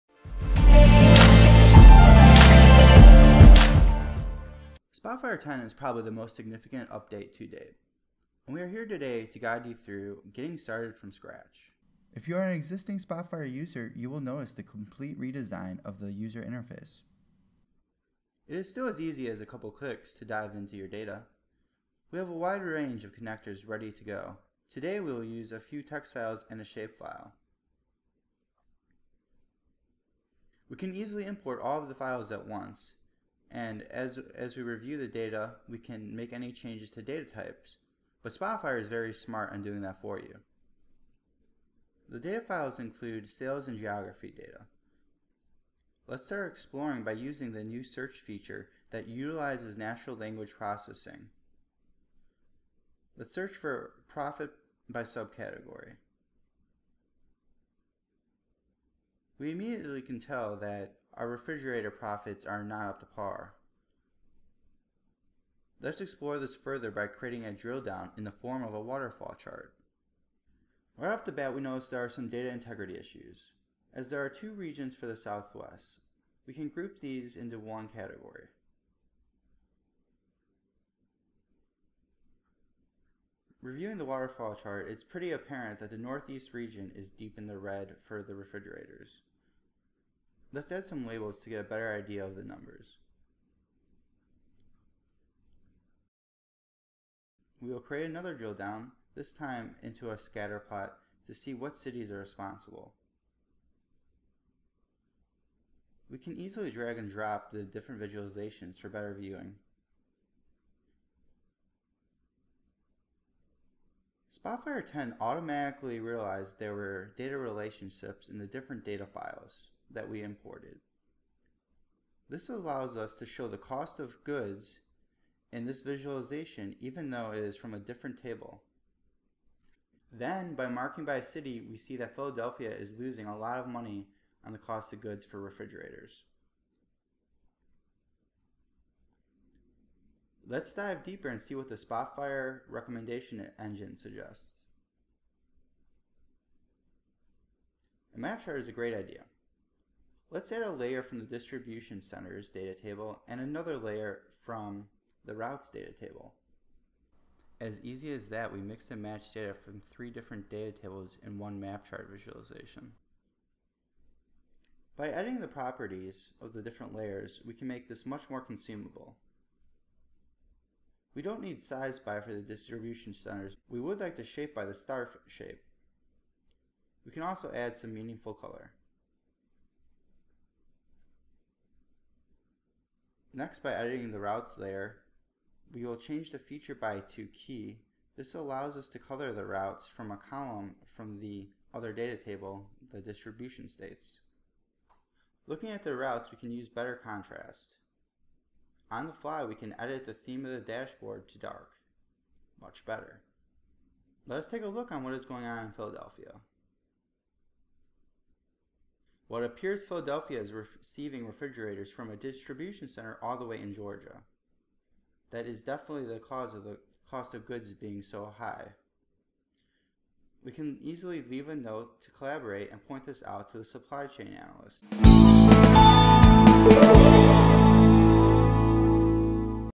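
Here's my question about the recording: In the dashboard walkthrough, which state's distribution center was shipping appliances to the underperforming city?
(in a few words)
Georgia.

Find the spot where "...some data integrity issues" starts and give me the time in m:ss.
1:12.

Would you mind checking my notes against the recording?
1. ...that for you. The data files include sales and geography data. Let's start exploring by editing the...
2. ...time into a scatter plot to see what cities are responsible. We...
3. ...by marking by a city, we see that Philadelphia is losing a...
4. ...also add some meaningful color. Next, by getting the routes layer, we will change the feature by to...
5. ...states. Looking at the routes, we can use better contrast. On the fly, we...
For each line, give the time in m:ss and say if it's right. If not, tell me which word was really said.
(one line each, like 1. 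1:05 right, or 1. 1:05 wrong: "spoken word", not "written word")
1. 0:39 wrong: "using", not "editing"
2. 1:39 right
3. 2:10 right
4. 2:57 wrong: "editing", not "getting"
5. 3:13 right.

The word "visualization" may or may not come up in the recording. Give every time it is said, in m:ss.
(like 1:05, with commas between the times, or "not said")
1:48, 2:05, 2:42.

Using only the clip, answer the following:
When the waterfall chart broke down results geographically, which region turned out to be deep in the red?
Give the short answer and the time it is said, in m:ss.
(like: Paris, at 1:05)
Northeast, at 1:25.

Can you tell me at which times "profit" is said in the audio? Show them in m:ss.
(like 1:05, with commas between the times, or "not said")
0:54, 1:01.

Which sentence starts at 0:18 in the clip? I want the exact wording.
It is still as easy as a couple clicks to dive into your data.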